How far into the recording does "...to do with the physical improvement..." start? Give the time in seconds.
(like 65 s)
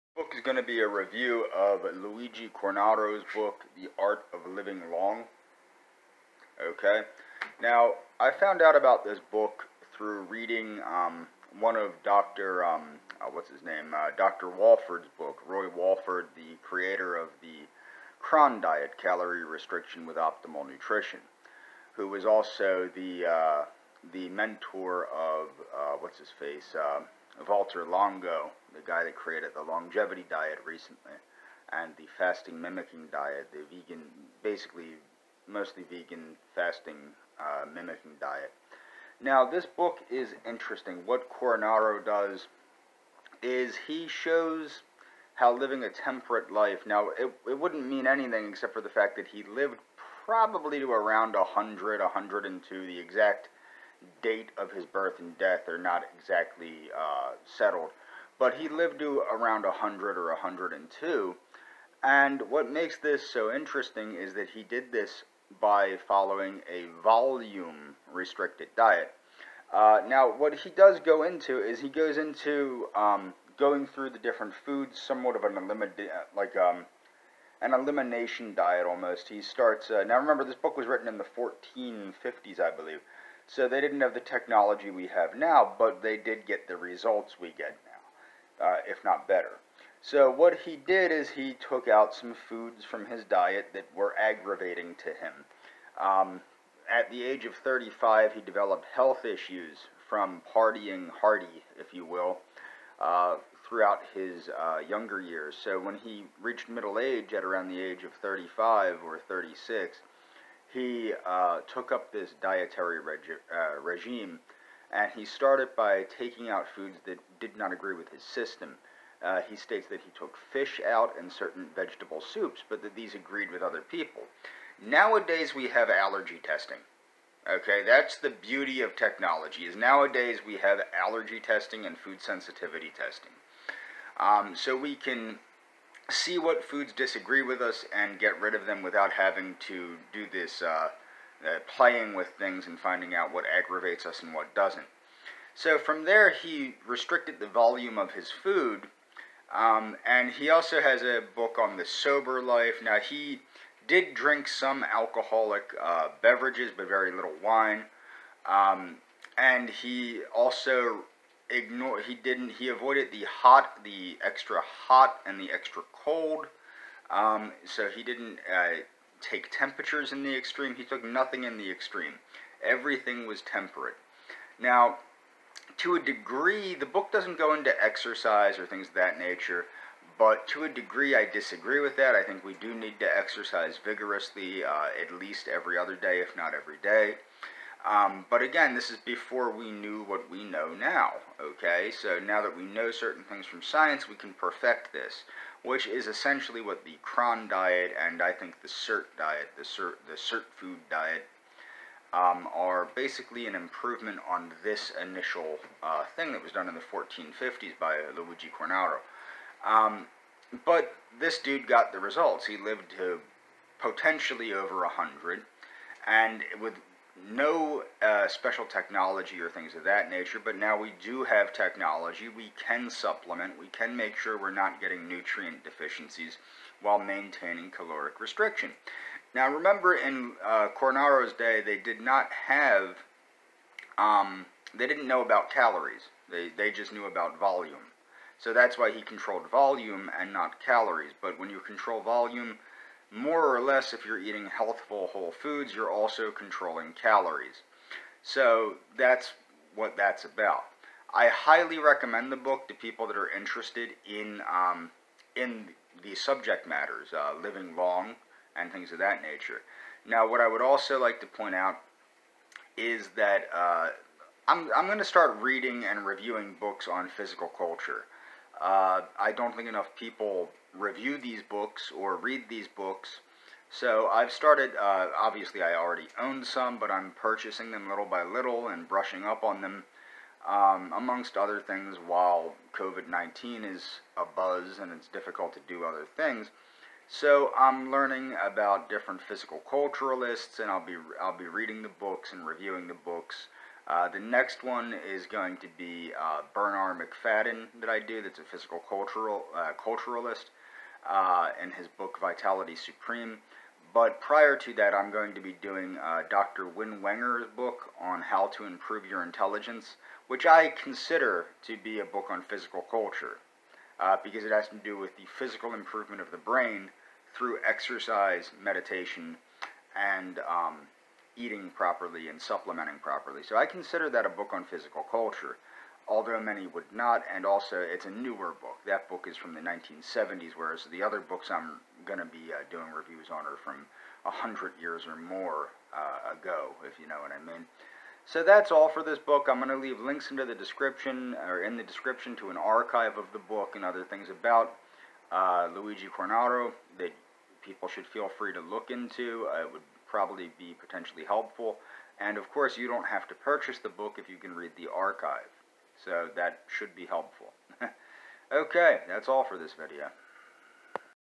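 314 s.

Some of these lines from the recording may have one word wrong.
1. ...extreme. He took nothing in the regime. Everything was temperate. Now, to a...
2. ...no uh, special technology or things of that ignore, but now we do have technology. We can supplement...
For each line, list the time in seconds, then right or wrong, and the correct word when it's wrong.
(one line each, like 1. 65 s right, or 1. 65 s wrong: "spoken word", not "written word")
1. 170 s wrong: "extreme", not "regime"
2. 217 s wrong: "nature", not "ignore".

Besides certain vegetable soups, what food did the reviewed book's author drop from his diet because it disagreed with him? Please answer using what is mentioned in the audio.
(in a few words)
fish.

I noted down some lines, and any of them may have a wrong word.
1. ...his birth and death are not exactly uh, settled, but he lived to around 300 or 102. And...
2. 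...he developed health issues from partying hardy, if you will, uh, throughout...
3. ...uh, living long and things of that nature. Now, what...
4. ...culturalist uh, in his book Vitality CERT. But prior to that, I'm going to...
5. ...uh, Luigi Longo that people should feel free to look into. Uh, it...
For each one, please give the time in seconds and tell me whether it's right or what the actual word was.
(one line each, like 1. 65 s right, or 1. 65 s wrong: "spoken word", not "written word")
1. 54 s wrong: "100", not "300"
2. 98 s right
3. 257 s right
4. 299 s wrong: "Supreme", not "CERT"
5. 345 s wrong: "Cornaro", not "Longo".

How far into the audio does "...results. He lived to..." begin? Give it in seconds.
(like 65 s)
211 s.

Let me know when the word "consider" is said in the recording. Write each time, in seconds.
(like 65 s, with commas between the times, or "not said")
310 s, 323 s.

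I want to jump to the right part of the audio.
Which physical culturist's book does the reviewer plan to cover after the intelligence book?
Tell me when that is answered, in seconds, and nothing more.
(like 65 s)
296 s.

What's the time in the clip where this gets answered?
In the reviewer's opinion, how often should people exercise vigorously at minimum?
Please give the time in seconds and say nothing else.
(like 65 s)
185 s.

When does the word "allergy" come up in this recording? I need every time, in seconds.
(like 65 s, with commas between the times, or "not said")
125 s, 131 s.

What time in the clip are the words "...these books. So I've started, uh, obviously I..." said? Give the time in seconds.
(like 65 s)
272 s.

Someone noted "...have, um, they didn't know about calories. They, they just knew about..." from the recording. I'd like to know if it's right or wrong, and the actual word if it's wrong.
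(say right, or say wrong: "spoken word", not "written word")
right.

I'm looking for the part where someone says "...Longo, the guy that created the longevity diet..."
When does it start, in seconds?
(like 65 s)
27 s.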